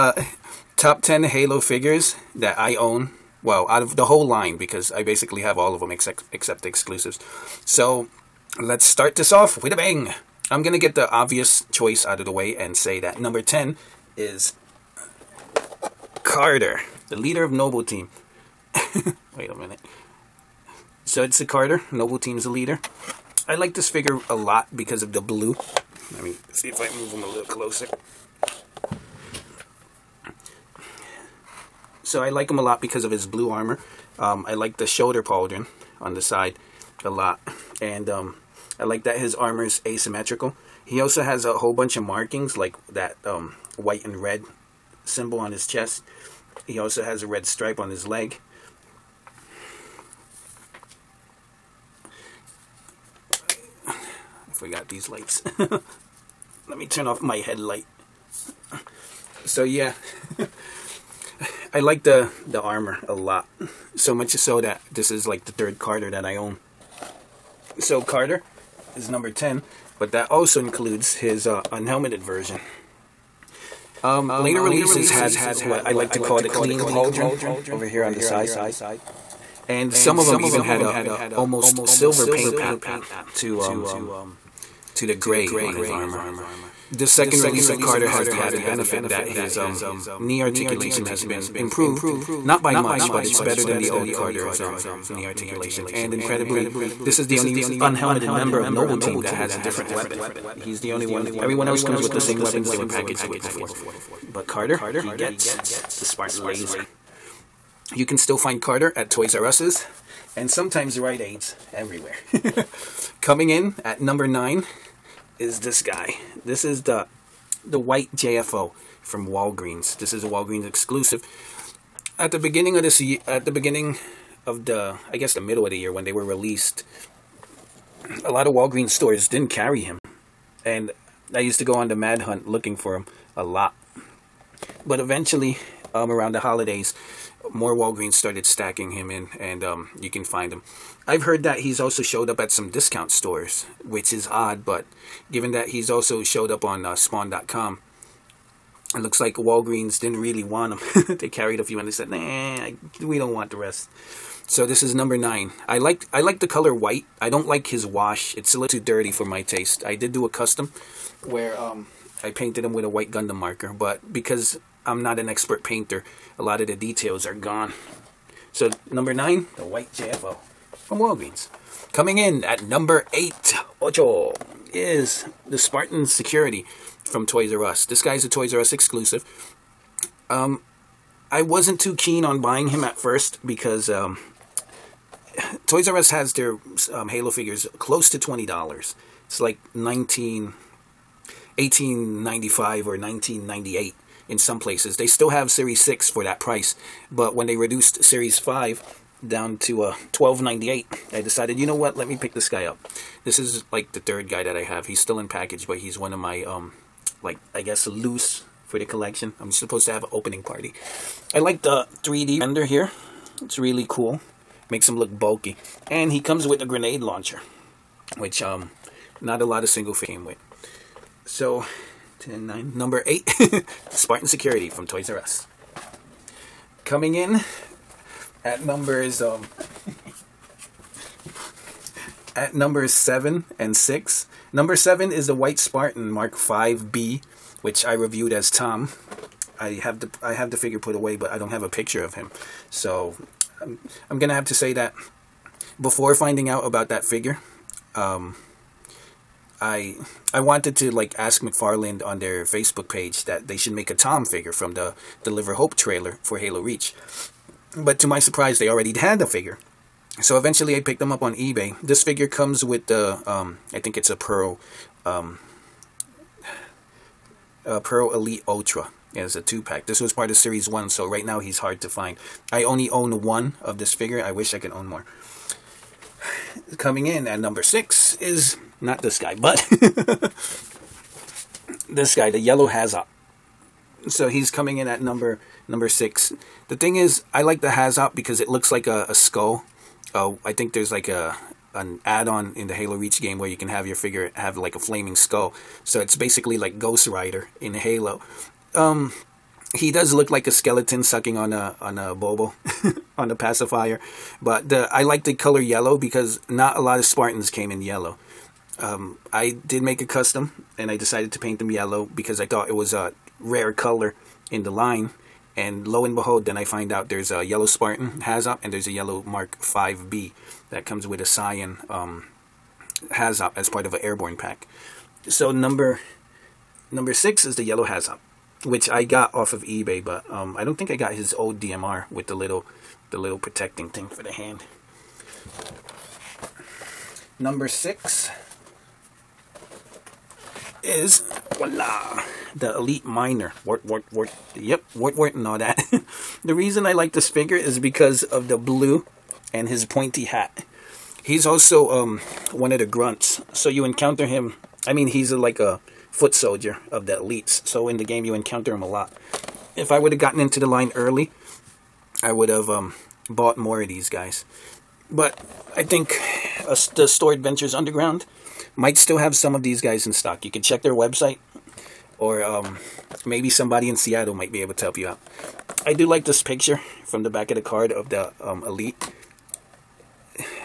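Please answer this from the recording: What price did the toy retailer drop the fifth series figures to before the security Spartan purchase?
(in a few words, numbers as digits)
$12.98.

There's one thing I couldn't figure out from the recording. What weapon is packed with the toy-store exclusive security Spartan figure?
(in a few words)
Grenade launcher.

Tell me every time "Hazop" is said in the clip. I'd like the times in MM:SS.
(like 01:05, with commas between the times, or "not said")
04:42, 05:18, 05:23, 05:27.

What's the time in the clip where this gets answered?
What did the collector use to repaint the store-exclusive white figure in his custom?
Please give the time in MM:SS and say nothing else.
02:42.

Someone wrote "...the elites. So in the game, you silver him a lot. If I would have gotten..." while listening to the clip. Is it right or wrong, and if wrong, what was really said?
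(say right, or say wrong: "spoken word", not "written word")
wrong: "encounter", not "silver".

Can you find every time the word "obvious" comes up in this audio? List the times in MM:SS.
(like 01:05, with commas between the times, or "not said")
00:11.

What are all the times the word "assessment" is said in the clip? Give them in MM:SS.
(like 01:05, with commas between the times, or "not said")
not said.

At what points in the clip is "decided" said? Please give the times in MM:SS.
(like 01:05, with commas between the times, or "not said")
03:21, 05:10.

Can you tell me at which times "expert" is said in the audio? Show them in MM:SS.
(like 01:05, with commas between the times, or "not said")
02:45.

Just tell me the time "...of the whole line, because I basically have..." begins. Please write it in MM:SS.
00:03.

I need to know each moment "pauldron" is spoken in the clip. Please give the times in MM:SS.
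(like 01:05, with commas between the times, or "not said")
00:35, 01:16.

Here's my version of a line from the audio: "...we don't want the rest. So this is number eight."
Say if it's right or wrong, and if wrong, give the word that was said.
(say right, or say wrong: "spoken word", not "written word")
wrong: "nine", not "eight".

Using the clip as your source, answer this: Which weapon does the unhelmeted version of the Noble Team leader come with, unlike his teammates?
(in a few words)
Spartan Laser.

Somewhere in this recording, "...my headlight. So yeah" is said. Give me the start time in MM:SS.
00:57.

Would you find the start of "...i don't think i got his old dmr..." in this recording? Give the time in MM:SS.
05:30.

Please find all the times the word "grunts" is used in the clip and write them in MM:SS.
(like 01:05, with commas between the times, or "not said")
05:52.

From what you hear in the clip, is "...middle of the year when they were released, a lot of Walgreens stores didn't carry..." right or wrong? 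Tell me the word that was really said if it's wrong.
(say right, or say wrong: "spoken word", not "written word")
right.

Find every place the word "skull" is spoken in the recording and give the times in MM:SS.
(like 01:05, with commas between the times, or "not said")
04:49, 04:55.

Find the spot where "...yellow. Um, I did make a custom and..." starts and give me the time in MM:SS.
05:07.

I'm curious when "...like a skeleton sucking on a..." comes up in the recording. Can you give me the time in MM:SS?
05:00.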